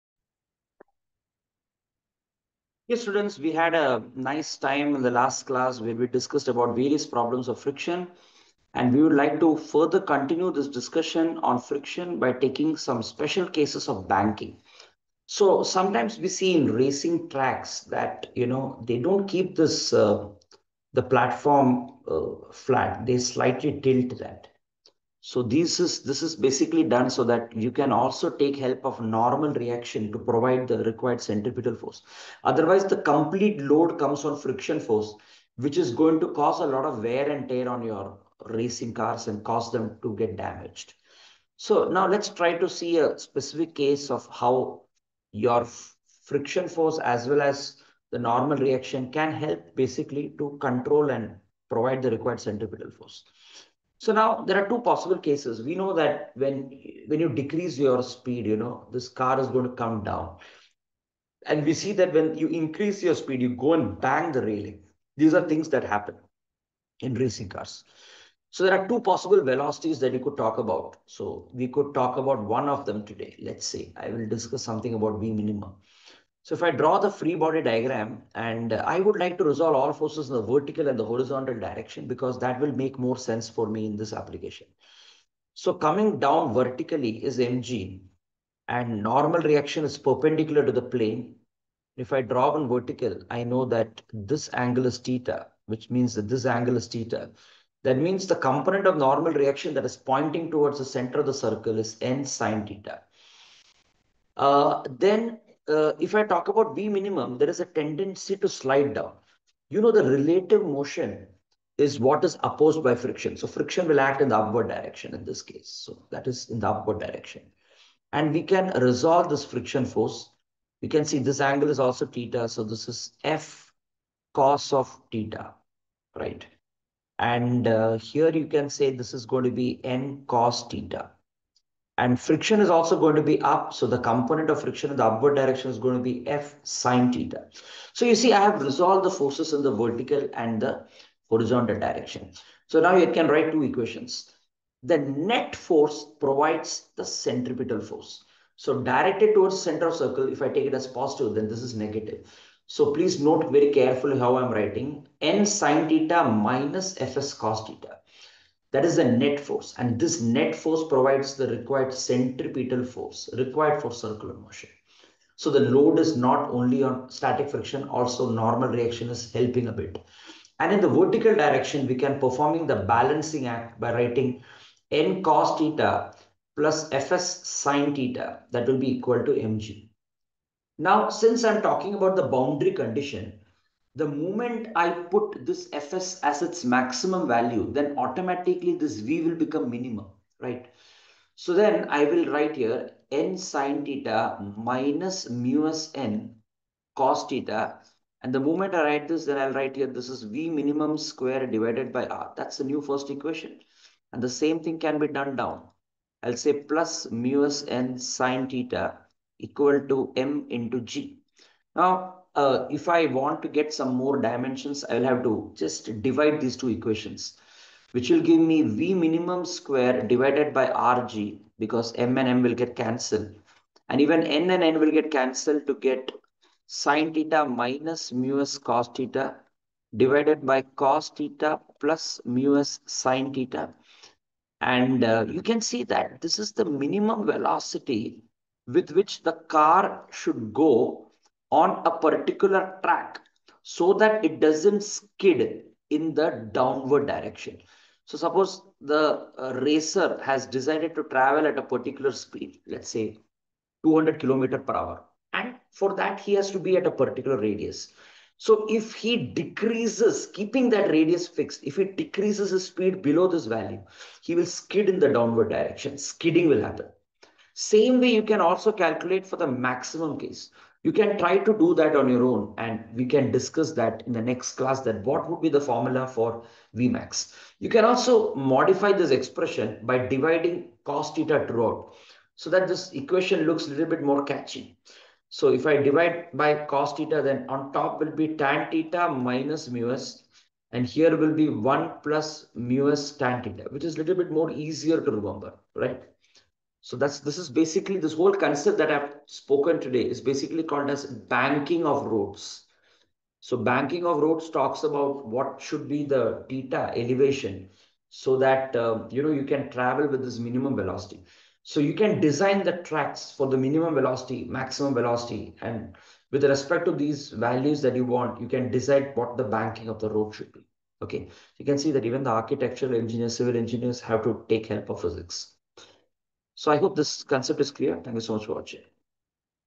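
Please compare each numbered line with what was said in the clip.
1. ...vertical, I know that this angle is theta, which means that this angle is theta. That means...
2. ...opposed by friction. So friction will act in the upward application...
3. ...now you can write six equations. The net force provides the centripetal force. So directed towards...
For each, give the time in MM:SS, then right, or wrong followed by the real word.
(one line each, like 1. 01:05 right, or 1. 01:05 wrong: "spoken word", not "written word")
1. 01:32 right
2. 01:52 wrong: "direction", not "application"
3. 02:22 wrong: "two", not "six".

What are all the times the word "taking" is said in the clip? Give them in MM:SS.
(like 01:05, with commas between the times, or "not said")
00:12.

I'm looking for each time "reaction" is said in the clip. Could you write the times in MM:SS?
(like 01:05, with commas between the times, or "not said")
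00:29, 00:48, 01:29, 01:39, 02:48.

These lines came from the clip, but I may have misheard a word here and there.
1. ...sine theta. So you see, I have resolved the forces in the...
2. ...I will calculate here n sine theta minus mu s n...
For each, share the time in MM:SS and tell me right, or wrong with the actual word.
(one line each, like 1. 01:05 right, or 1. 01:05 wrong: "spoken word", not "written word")
1. 02:16 right
2. 03:11 wrong: "write", not "calculate".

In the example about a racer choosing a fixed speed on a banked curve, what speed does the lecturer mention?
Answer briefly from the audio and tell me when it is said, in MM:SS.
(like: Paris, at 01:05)
200 km/h, at 04:13.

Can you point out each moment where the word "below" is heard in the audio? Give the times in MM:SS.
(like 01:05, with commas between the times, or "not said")
04:23.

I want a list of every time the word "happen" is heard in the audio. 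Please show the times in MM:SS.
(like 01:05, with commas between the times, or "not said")
01:05, 04:26.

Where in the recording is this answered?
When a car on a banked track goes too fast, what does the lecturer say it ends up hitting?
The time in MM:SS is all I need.
01:04.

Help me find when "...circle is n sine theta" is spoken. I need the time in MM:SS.
01:41.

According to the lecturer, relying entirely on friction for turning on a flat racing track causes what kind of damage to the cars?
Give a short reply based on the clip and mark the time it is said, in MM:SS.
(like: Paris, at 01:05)
wear and tear, at 00:37.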